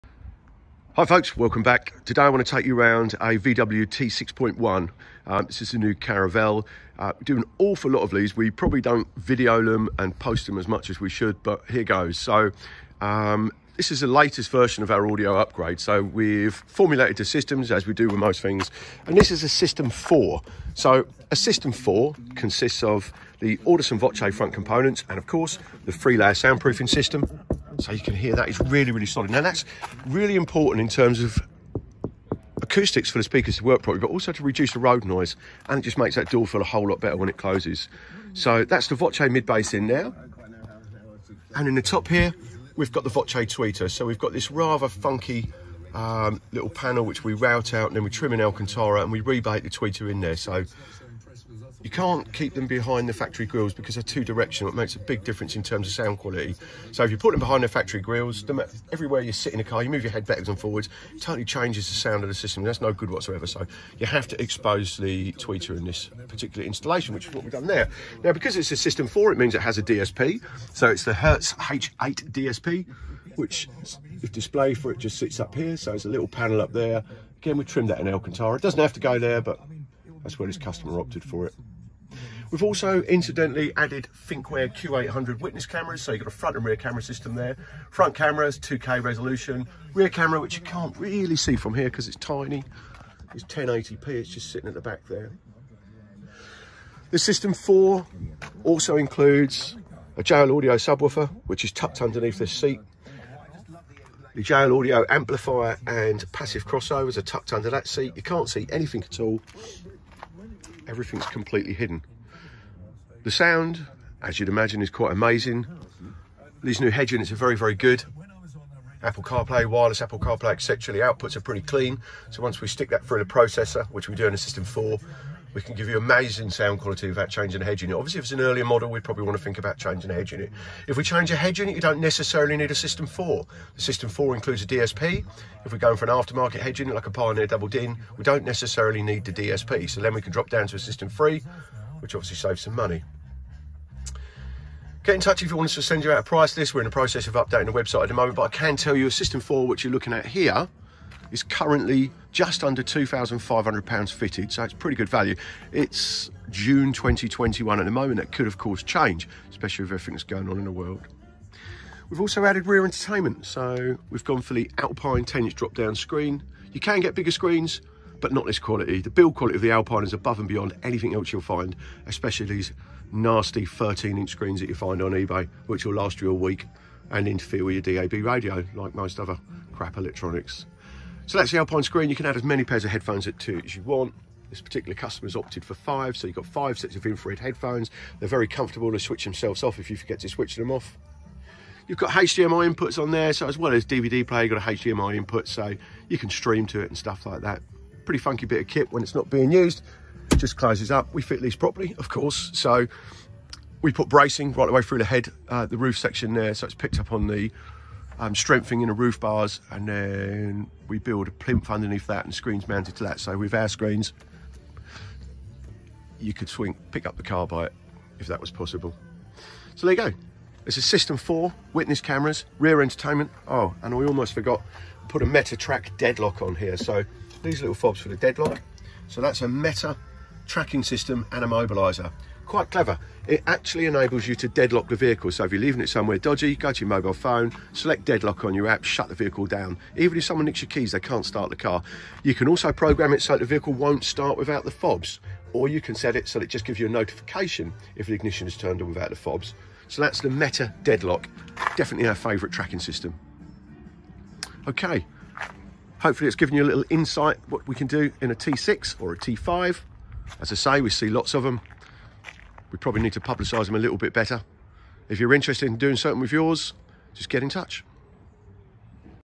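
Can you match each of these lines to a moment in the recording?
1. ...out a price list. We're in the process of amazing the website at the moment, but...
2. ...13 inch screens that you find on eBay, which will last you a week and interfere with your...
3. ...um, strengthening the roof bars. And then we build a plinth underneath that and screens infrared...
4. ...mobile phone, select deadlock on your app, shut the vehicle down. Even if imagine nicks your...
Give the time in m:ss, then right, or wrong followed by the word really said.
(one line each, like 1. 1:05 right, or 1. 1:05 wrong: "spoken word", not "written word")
1. 2:26 wrong: "updating", not "amazing"
2. 2:53 right
3. 3:28 wrong: "mounted", not "infrared"
4. 3:56 wrong: "someone", not "imagine".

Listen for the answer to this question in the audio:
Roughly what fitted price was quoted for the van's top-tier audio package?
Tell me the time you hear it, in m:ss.
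2:32.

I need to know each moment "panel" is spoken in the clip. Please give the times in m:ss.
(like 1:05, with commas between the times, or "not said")
0:46, 1:16.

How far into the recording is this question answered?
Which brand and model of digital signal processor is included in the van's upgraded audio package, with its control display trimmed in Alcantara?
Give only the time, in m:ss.
1:11.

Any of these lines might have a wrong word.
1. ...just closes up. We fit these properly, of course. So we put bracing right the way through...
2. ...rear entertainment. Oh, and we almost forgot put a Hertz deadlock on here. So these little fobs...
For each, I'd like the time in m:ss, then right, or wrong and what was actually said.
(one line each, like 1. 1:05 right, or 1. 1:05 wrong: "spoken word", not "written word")
1. 3:20 right
2. 3:42 wrong: "MetaTrak", not "Hertz".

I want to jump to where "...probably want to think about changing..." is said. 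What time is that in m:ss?
2:08.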